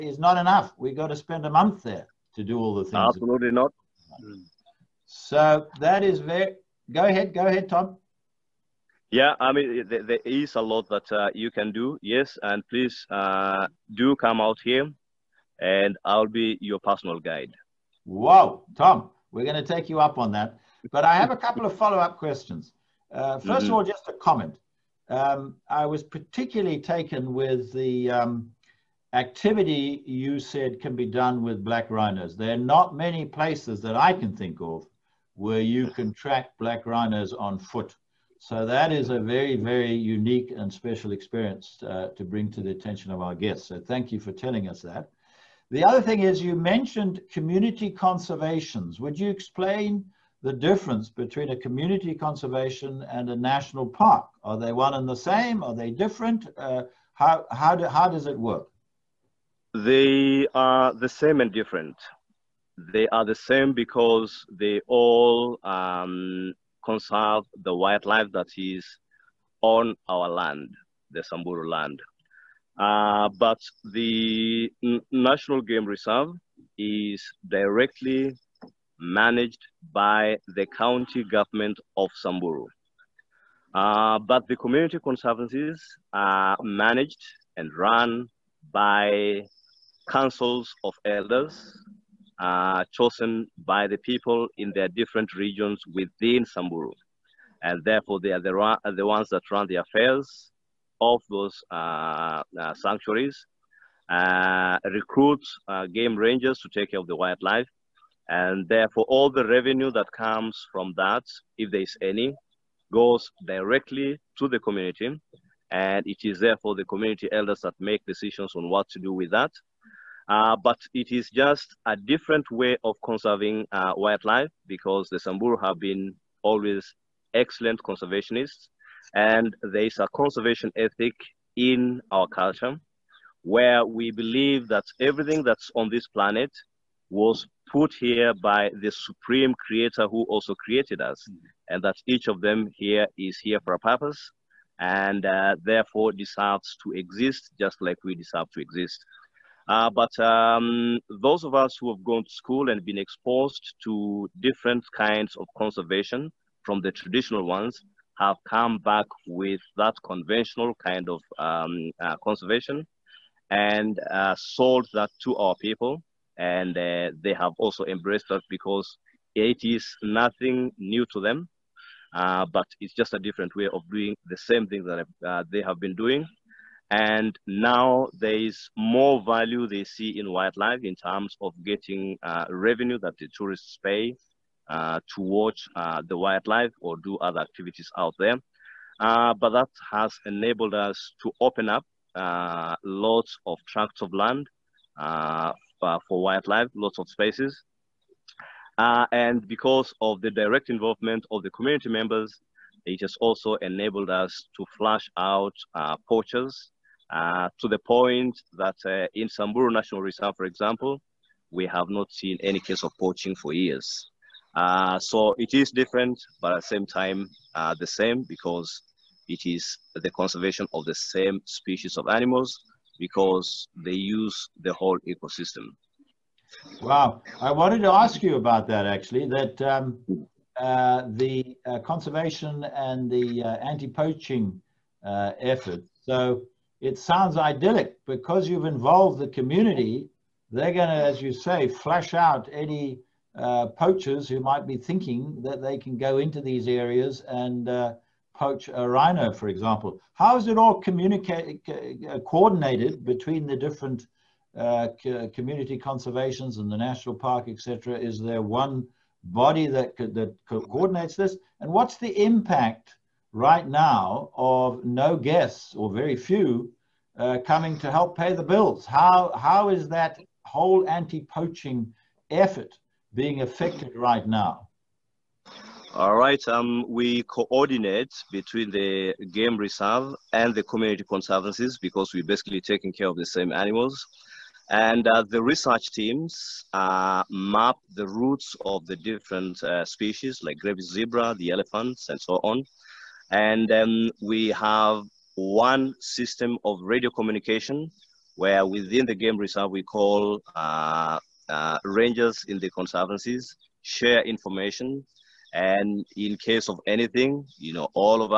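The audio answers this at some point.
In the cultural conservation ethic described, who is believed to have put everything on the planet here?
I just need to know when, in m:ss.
2:18.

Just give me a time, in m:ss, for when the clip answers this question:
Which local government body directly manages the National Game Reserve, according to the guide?
1:20.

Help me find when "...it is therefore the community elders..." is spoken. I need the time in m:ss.
1:56.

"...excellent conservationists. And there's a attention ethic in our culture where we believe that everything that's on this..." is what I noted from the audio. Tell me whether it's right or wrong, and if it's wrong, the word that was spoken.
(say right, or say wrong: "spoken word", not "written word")
wrong: "conservation", not "attention".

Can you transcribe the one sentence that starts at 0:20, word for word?
But I have a couple of follow-up questions.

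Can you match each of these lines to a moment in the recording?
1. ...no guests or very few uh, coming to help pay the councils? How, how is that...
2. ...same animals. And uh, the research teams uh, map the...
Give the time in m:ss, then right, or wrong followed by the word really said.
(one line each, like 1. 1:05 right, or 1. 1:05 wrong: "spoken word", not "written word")
1. 4:24 wrong: "bills", not "councils"
2. 4:43 right.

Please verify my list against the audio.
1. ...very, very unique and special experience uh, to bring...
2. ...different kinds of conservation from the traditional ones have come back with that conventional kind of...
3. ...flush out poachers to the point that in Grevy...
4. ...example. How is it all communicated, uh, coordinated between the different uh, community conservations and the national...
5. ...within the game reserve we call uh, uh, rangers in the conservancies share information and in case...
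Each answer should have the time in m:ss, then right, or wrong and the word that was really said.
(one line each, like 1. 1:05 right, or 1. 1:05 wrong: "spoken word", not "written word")
1. 0:39 right
2. 2:34 right
3. 3:24 wrong: "Samburu", not "Grevy"
4. 4:09 right
5. 4:58 right.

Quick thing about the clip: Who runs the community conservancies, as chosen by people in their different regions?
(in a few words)
Councils of elders.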